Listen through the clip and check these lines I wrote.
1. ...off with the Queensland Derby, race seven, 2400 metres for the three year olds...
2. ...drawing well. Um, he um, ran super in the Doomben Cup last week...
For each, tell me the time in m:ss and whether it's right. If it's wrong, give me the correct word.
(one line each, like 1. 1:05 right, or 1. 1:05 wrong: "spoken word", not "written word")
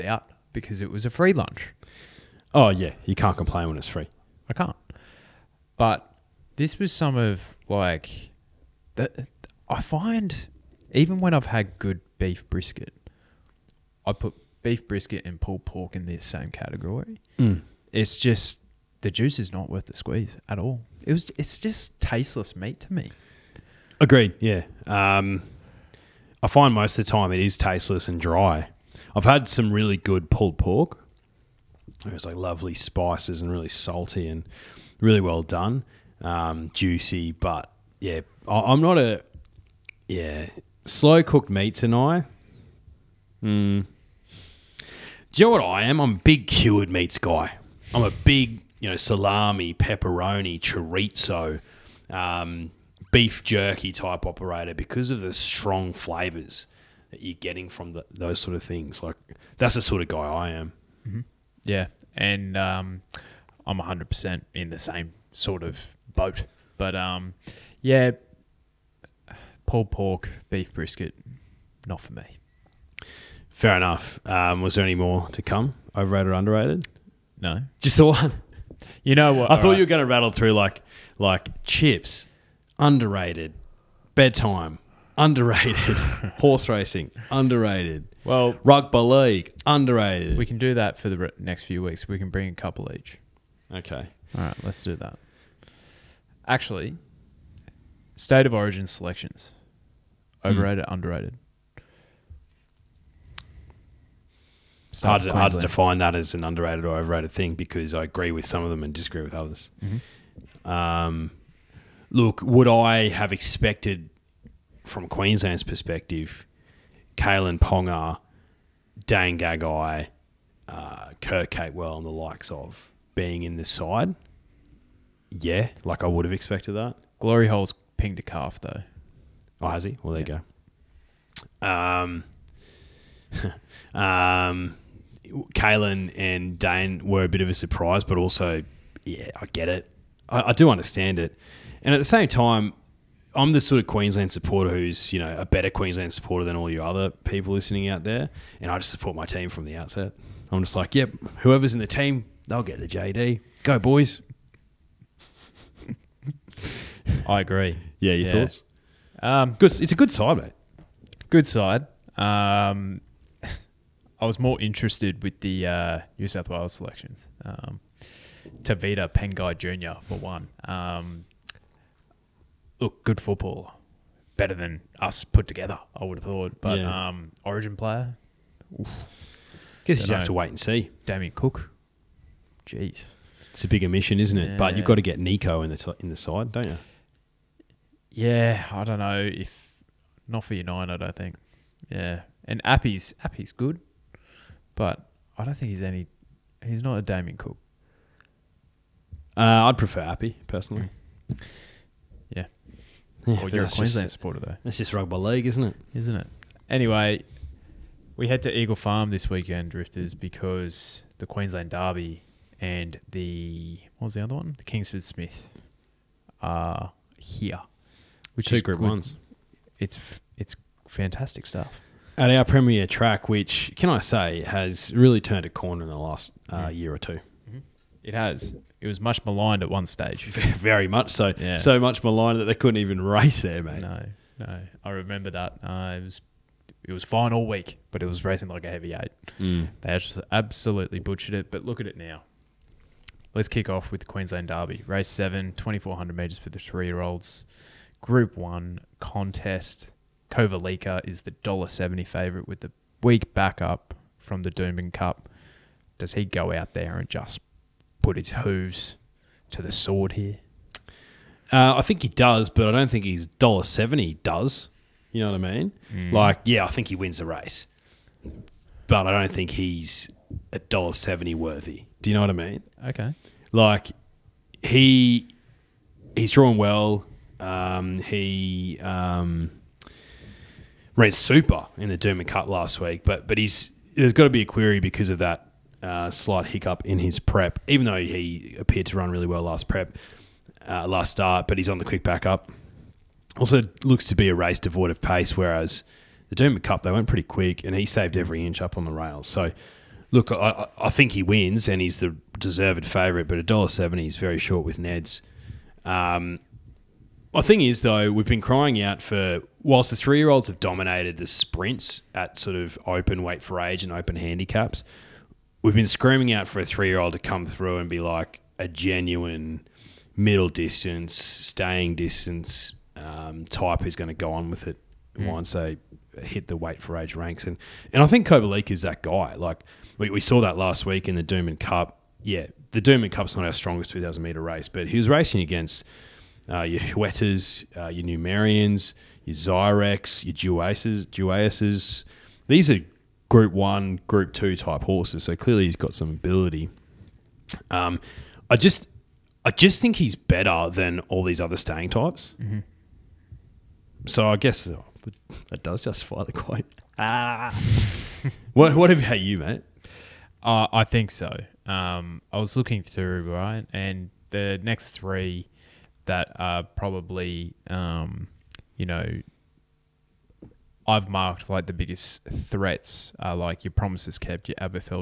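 1. 4:03 right
2. 4:36 right.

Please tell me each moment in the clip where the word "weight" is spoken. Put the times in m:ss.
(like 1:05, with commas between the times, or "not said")
5:13, 5:26.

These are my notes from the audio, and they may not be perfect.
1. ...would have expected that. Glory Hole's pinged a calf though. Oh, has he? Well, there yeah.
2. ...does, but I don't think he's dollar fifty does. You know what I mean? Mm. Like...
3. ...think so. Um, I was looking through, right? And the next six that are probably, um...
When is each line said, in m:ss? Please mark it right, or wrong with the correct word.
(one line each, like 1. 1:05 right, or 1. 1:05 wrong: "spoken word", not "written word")
1. 2:06 right
2. 4:22 wrong: "seventy", not "fifty"
3. 6:00 wrong: "three", not "six".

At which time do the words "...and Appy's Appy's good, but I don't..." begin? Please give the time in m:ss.
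3:12.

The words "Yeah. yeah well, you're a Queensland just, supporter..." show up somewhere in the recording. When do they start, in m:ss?
3:22.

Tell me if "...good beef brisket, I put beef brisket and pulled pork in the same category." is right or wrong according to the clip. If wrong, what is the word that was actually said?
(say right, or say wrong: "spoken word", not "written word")
right.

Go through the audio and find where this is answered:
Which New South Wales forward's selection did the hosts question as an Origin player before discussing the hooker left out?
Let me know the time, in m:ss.
2:48.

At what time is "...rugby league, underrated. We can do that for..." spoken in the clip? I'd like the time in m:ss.
1:28.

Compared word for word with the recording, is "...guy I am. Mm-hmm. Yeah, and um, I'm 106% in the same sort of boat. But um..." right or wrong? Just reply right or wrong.
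wrong.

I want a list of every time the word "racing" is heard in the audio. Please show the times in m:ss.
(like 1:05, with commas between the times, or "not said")
1:26, 3:58, 5:35.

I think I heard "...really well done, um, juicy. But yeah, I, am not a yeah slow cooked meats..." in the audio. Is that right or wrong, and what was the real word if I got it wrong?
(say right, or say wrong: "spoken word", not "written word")
right.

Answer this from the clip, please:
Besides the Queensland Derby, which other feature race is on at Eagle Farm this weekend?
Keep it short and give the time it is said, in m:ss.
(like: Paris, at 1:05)
The Kingsford Smith, at 3:34.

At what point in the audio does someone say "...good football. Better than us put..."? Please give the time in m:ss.
2:53.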